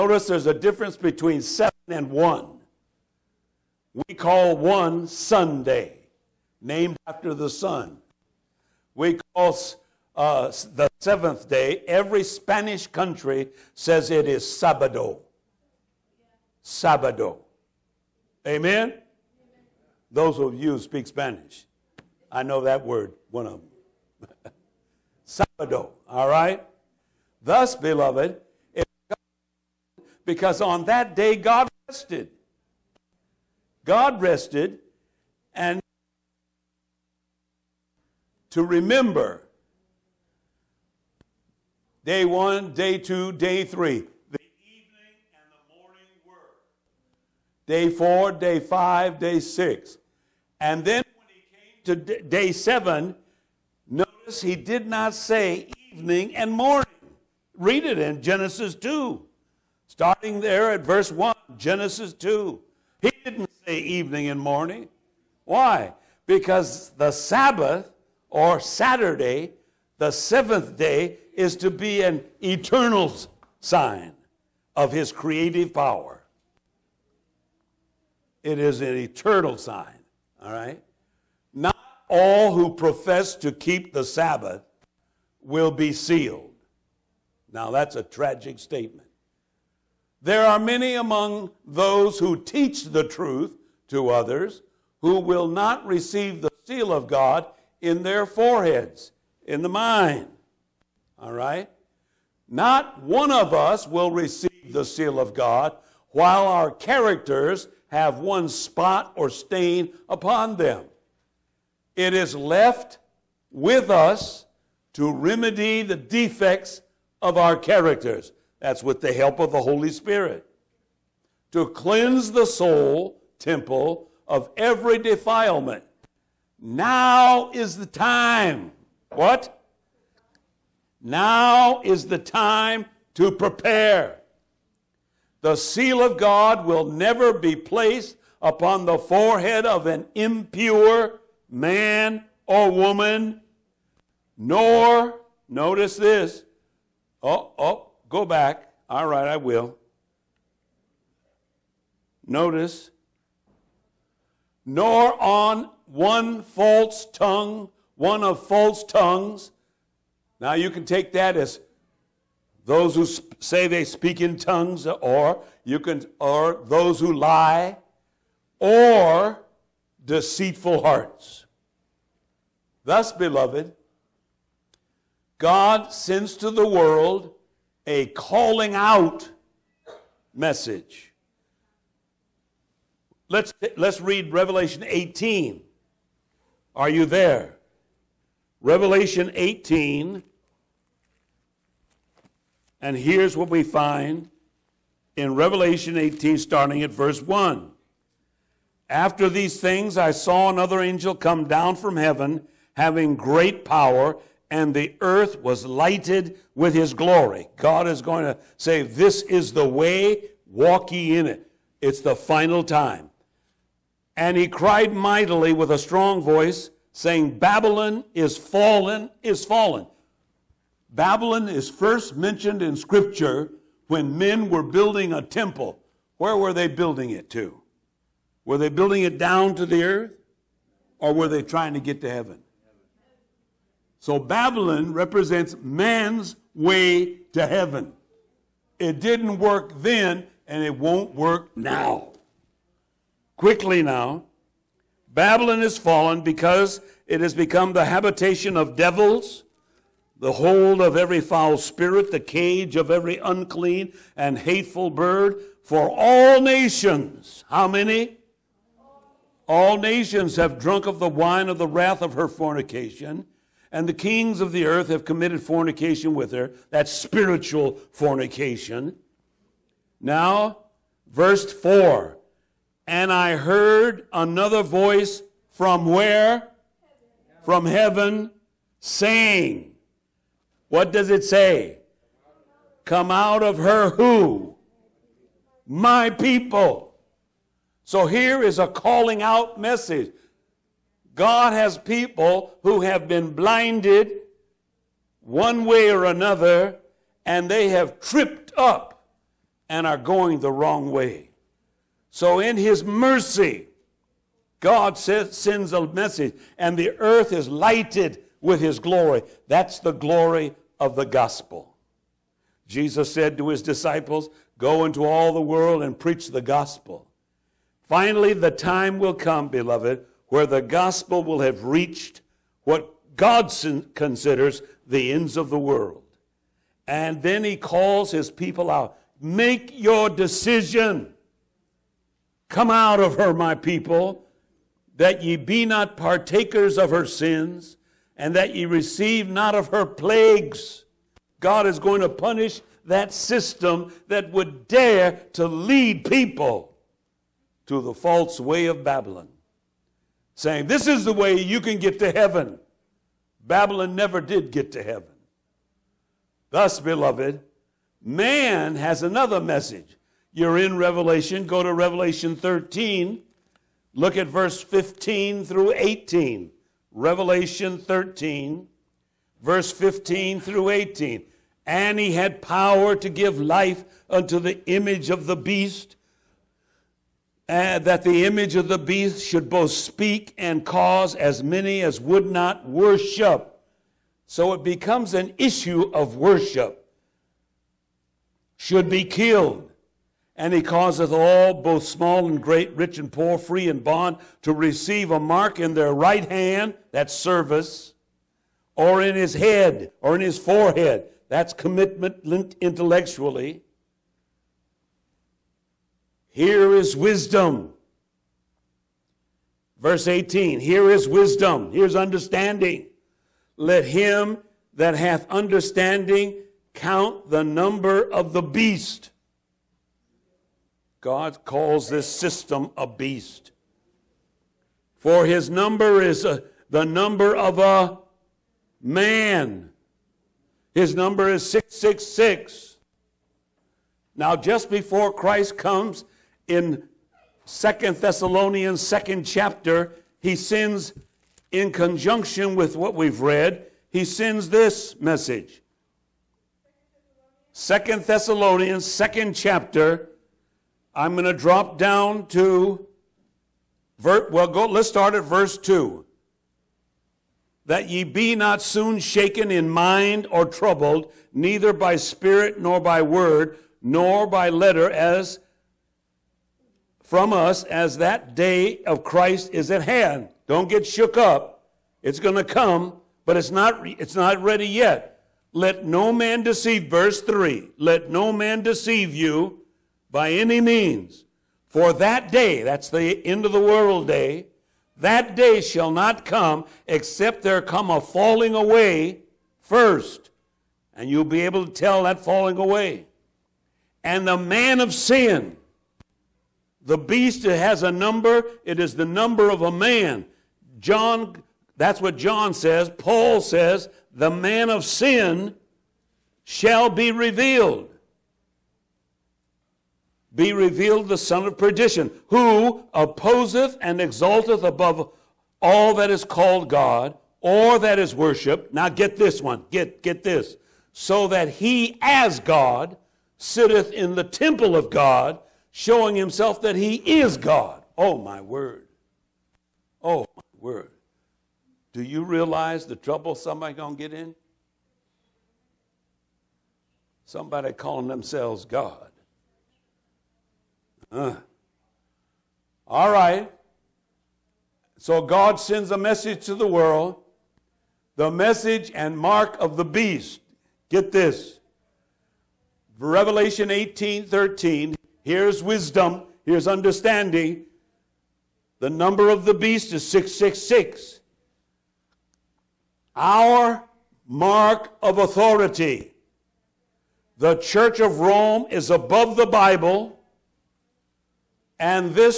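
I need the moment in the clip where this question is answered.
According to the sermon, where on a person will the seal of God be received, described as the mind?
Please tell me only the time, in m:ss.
1:38.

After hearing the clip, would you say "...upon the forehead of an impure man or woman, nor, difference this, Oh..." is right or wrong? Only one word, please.
wrong.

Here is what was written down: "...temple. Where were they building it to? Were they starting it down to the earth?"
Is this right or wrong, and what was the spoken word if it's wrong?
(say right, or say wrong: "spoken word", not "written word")
wrong: "building", not "starting".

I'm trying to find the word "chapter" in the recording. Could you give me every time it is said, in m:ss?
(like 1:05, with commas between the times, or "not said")
7:19, 7:29.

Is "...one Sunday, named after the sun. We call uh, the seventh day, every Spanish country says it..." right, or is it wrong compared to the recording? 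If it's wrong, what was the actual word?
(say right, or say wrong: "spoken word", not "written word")
right.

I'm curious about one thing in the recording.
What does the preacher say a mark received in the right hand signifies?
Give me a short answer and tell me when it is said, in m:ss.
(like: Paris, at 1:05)
service, at 6:37.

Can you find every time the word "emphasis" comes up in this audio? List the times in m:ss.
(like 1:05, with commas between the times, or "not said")
not said.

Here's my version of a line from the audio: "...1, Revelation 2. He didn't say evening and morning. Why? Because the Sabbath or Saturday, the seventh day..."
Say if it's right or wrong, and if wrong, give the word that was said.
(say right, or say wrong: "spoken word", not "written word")
wrong: "Genesis", not "Revelation".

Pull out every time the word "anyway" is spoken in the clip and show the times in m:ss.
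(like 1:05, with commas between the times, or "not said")
not said.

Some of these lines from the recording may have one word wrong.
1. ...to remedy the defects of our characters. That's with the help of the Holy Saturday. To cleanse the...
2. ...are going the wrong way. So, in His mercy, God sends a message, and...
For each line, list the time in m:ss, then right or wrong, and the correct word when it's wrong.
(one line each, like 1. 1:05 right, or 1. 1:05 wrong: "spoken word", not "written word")
1. 1:54 wrong: "Spirit", not "Saturday"
2. 4:59 right.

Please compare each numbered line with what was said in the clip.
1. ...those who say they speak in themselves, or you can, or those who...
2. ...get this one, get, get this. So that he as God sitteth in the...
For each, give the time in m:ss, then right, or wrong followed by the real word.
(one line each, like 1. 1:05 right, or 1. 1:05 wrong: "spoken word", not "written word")
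1. 2:42 wrong: "tongues", not "themselves"
2. 8:38 right.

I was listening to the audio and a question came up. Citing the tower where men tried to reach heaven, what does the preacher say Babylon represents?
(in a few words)
man's way to heaven.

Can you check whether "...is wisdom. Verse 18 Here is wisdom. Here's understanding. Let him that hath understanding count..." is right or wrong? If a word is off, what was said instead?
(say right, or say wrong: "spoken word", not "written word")
right.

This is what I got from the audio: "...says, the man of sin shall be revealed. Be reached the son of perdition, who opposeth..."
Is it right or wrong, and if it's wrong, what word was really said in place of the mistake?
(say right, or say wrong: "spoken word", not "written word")
wrong: "revealed", not "reached".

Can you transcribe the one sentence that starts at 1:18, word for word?
It is an eternal sign, all right?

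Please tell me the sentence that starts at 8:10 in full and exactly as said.
And you'll be able to tell that falling away.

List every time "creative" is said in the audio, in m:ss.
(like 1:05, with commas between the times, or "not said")
1:15.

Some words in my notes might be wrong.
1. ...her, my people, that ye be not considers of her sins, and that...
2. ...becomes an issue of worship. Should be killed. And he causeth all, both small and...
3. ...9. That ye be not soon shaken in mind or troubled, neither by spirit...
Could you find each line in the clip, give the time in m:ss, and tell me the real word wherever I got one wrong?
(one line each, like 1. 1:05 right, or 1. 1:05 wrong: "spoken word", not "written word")
1. 5:33 wrong: "partakers", not "considers"
2. 6:24 right
3. 7:35 wrong: "2", not "9".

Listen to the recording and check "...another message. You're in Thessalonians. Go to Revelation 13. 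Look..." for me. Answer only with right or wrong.
wrong.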